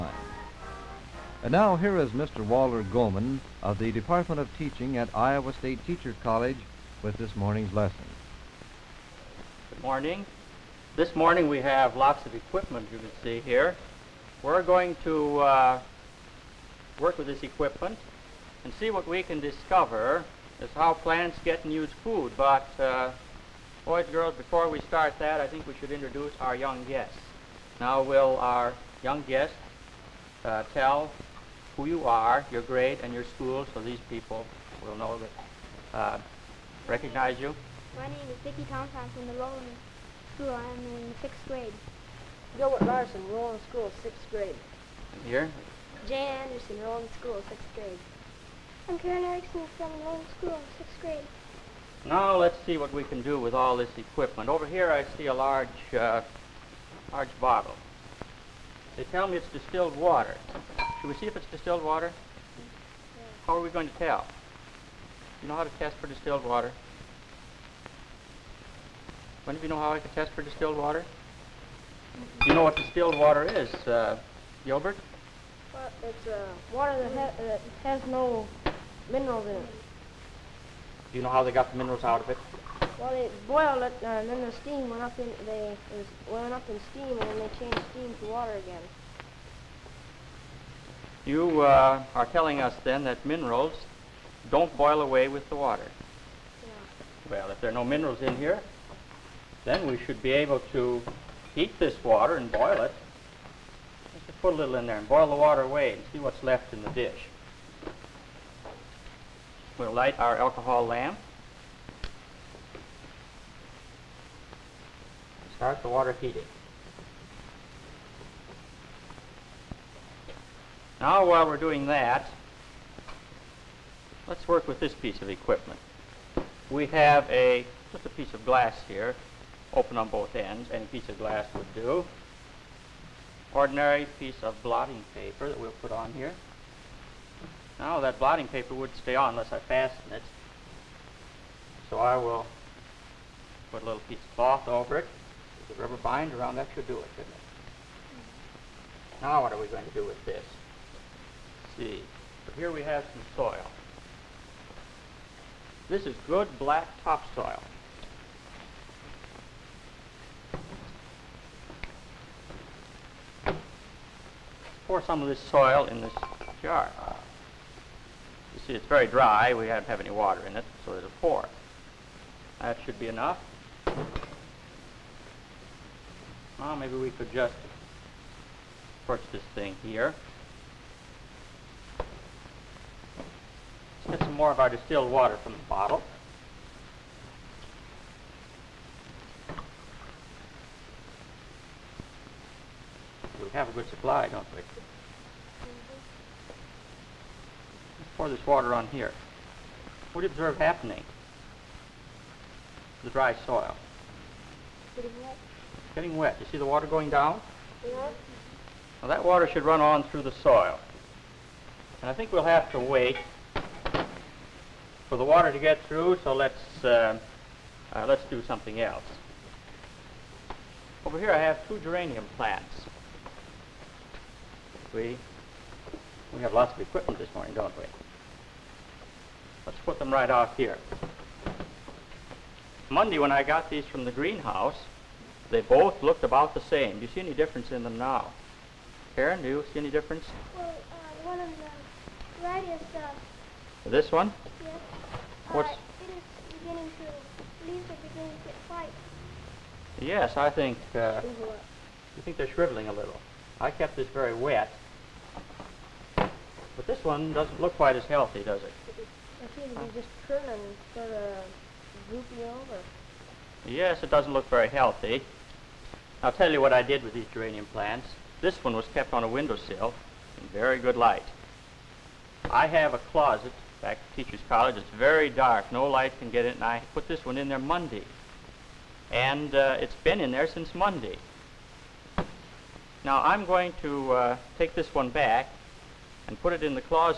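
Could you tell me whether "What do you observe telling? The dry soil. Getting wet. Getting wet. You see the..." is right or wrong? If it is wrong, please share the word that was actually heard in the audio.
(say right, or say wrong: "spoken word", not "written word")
wrong: "happening", not "telling".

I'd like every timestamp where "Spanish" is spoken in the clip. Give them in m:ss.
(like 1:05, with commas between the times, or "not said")
not said.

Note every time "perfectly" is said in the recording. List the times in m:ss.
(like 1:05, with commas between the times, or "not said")
not said.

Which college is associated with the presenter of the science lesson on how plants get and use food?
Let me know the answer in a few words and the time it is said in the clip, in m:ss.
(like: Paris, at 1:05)
Iowa State Teachers College, at 0:05.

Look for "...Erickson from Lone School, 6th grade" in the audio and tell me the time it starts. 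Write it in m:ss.
0:49.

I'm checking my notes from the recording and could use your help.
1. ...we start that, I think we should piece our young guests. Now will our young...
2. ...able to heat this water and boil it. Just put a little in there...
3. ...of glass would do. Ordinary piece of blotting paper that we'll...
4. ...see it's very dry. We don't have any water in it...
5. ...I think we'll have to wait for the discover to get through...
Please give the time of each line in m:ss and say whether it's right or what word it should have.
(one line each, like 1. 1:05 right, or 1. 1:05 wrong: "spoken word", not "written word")
1. 0:24 wrong: "introduce", not "piece"
2. 1:40 right
3. 2:11 right
4. 2:48 right
5. 3:32 wrong: "water", not "discover".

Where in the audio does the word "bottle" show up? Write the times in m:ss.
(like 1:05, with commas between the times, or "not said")
0:57, 3:05.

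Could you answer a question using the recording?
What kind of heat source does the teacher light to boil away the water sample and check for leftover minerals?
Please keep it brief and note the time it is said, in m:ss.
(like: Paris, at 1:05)
Alcohol lamp, at 1:50.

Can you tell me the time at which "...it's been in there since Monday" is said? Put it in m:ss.
4:39.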